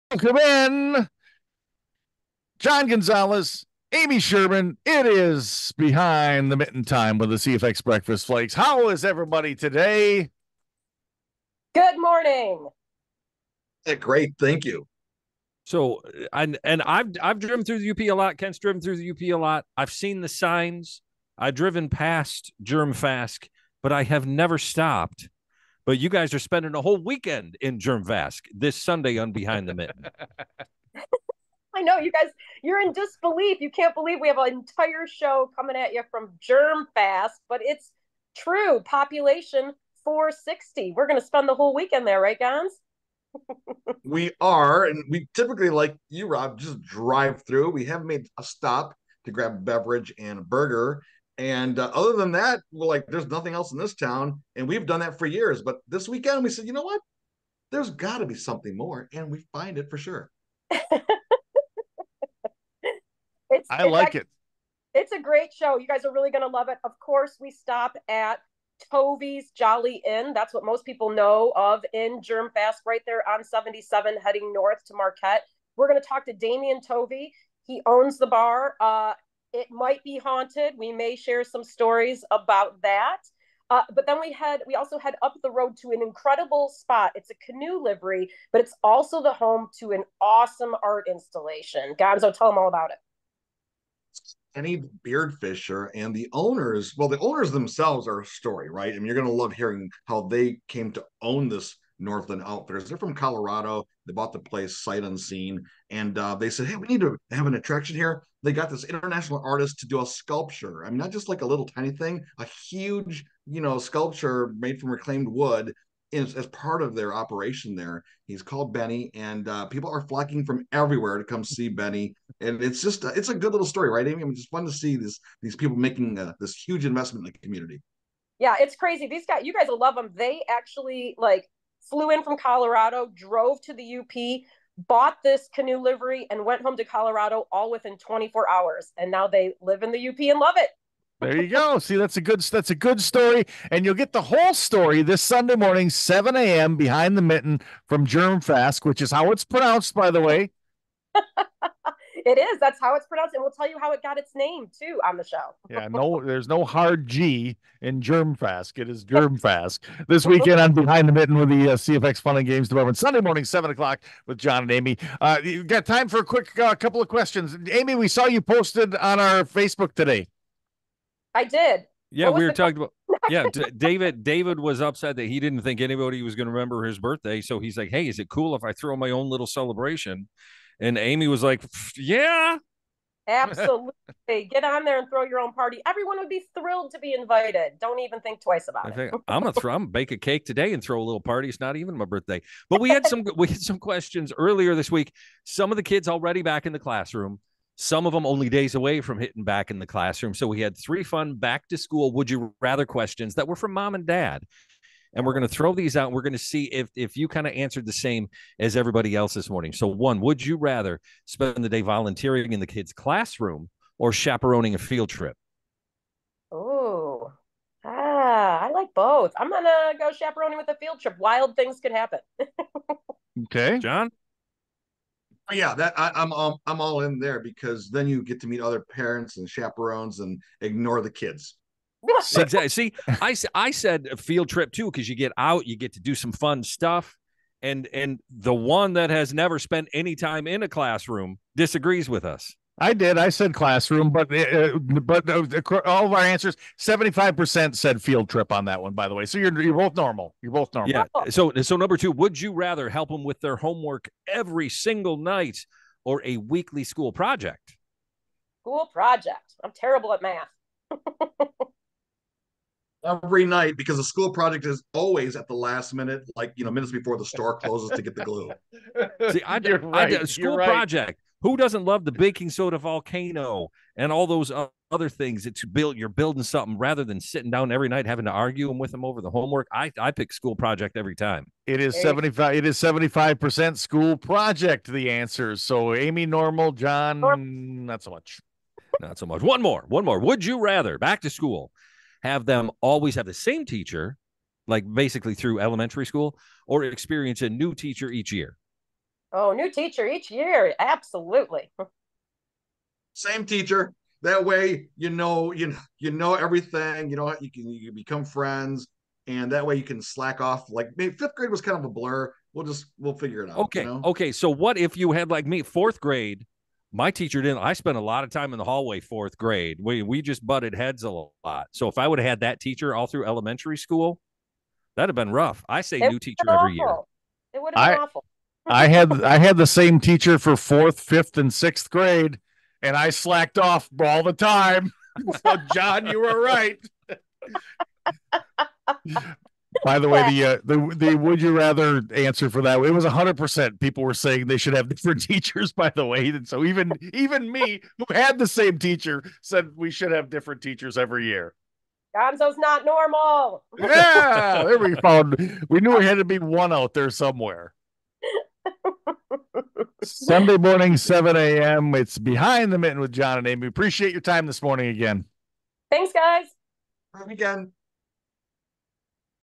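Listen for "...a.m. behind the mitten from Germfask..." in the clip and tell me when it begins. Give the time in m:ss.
2:26.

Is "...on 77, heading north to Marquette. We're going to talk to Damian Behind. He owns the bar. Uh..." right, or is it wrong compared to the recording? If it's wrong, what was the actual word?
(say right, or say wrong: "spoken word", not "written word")
wrong: "Tovey", not "Behind".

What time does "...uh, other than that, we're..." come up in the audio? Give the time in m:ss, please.
0:51.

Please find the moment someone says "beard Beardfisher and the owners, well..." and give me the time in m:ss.
1:35.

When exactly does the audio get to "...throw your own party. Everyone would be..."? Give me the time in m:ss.
3:05.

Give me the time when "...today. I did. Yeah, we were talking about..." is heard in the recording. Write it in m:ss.
2:49.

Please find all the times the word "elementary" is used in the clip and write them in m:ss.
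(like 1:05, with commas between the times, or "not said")
4:55, 5:23.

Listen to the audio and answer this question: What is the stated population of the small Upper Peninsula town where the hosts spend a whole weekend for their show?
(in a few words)
460.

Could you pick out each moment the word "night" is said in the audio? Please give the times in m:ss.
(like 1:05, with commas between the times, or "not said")
4:15, 4:23, 4:37.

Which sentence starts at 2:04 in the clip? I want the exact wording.
I mean, it's fun to see these these people making uh, this huge investment in the community.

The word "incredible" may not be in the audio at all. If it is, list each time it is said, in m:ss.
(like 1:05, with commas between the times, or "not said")
1:26.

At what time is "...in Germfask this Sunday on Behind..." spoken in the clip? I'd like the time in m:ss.
0:27.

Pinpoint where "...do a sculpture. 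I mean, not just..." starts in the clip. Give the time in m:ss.
1:49.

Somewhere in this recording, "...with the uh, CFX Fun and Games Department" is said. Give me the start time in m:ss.
2:41.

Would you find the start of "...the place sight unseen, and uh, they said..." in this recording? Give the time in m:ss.
1:44.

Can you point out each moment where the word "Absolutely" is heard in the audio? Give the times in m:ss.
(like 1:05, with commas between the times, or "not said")
3:03, 5:00.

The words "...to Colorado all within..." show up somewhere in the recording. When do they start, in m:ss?
2:16.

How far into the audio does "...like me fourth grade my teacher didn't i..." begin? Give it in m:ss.
5:15.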